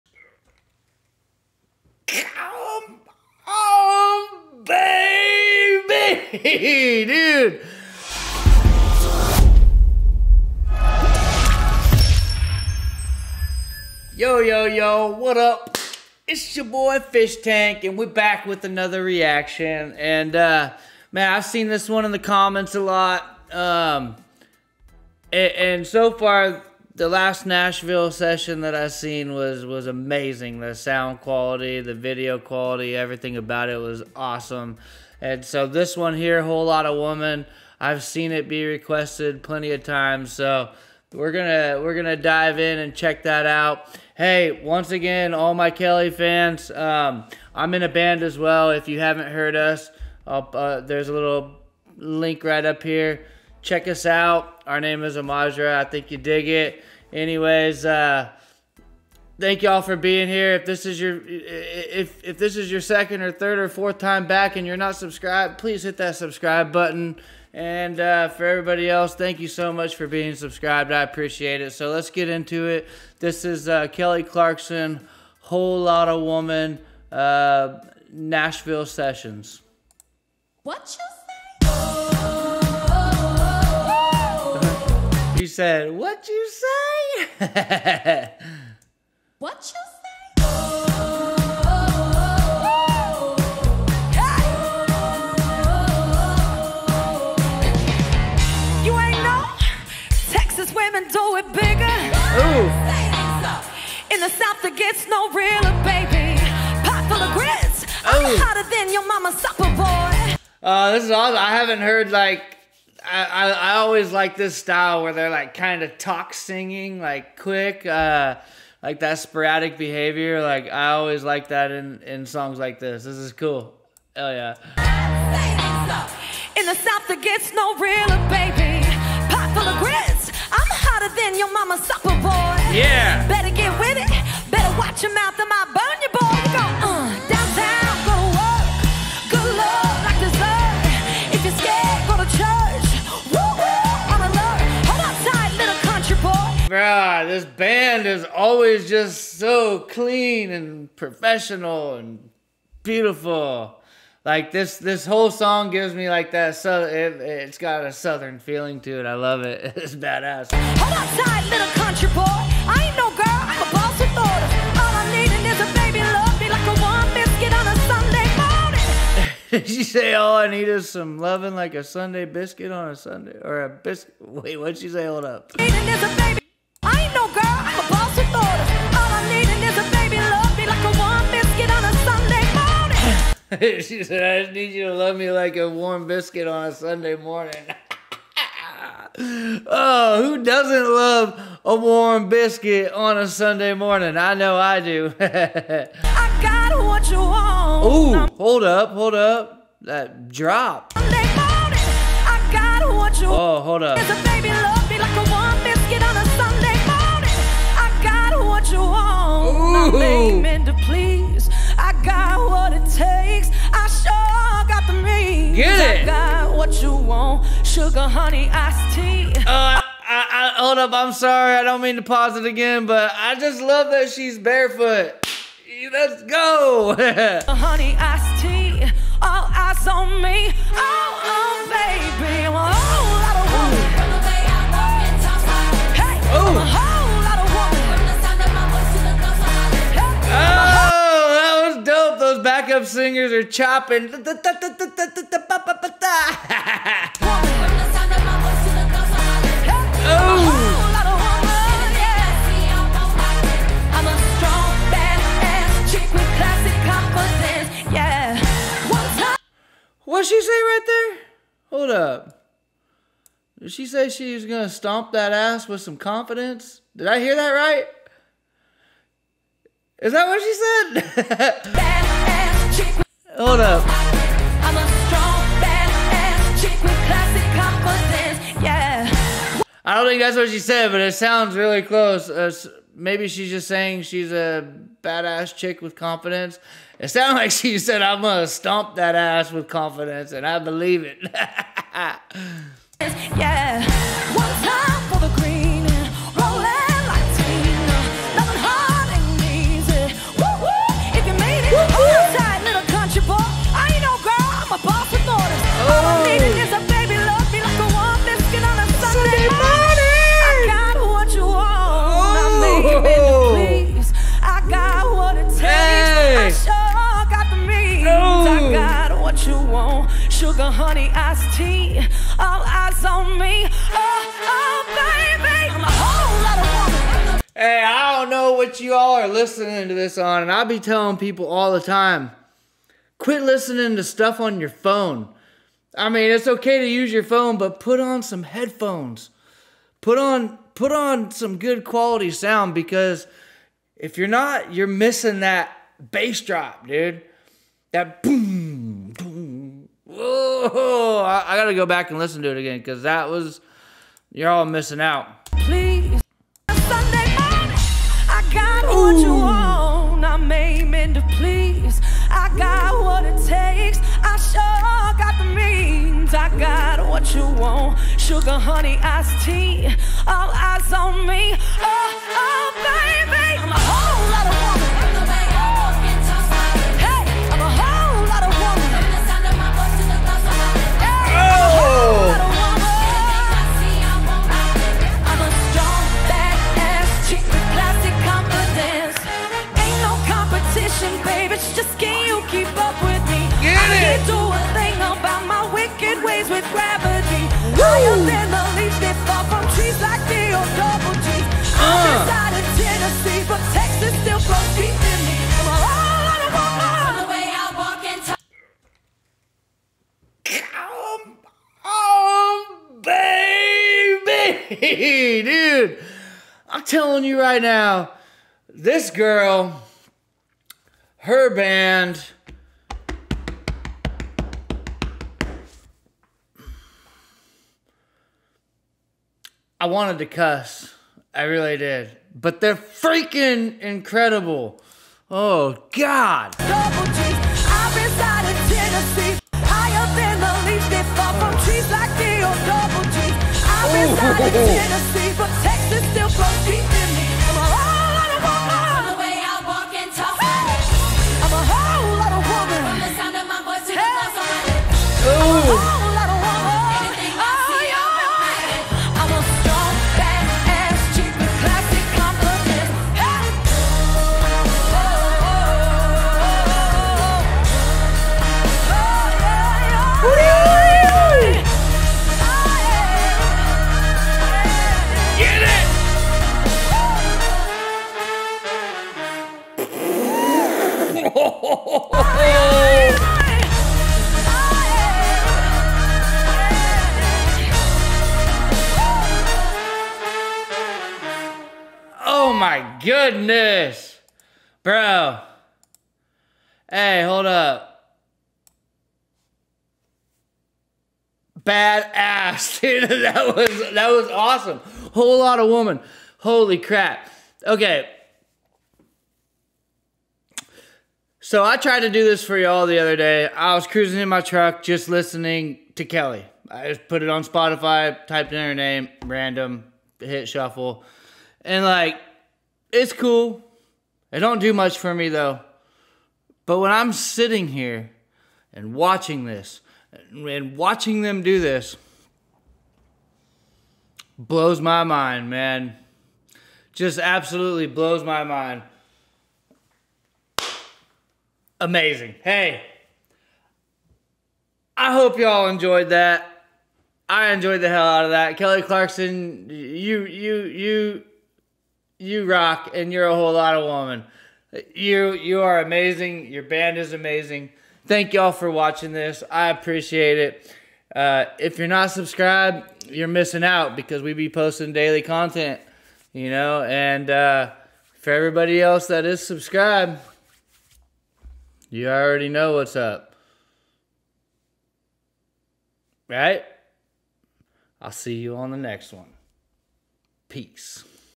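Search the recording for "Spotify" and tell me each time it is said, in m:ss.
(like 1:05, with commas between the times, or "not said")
8:37.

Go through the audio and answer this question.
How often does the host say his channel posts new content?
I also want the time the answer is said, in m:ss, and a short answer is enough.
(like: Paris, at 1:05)
daily, at 9:24.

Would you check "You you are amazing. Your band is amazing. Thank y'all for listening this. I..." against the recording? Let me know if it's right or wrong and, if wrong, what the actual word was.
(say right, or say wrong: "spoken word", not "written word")
wrong: "watching", not "listening".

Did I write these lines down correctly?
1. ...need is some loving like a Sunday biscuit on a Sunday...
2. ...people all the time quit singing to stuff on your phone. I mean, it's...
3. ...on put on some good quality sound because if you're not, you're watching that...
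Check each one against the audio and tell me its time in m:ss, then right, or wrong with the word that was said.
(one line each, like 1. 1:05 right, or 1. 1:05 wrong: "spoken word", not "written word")
1. 2:50 right
2. 5:31 wrong: "listening", not "singing"
3. 5:40 wrong: "missing", not "watching".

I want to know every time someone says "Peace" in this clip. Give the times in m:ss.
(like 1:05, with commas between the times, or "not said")
9:40.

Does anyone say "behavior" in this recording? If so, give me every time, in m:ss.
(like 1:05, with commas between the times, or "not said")
1:59.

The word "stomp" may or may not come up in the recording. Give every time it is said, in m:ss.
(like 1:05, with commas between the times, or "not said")
4:24, 4:48.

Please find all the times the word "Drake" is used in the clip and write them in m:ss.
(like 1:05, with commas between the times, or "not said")
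not said.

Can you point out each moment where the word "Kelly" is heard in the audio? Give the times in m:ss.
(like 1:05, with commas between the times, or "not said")
0:45, 1:13, 8:36, 9:08.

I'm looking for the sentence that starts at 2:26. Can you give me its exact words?
God, this band is always just so clean and professional and beautiful.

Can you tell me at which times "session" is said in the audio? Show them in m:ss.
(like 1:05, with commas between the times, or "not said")
0:28, 1:18.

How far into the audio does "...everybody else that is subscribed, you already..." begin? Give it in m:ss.
9:28.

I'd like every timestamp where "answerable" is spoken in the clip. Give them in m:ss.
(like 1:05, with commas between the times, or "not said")
not said.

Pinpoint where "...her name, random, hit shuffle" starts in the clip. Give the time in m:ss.
8:38.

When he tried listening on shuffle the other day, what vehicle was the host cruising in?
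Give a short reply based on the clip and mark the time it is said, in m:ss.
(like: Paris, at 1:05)
truck, at 8:34.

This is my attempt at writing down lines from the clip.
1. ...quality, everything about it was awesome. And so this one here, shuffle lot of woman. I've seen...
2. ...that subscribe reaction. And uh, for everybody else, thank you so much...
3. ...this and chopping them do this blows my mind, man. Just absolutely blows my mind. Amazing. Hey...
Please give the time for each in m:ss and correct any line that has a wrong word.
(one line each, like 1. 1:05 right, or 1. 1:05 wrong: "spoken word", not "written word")
1. 0:32 wrong: "whole", not "shuffle"
2. 1:05 wrong: "button", not "reaction"
3. 8:49 wrong: "watching", not "chopping".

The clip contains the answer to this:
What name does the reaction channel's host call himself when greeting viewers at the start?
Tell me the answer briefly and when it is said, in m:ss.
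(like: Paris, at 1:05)
Fischtank, at 0:16.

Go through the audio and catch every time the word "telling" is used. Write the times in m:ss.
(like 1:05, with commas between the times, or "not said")
5:30.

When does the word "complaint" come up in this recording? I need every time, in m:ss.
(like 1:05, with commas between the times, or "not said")
not said.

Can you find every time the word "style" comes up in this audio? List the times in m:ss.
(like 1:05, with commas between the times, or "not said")
1:54.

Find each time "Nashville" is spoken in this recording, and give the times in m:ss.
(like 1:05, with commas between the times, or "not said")
0:27, 1:18.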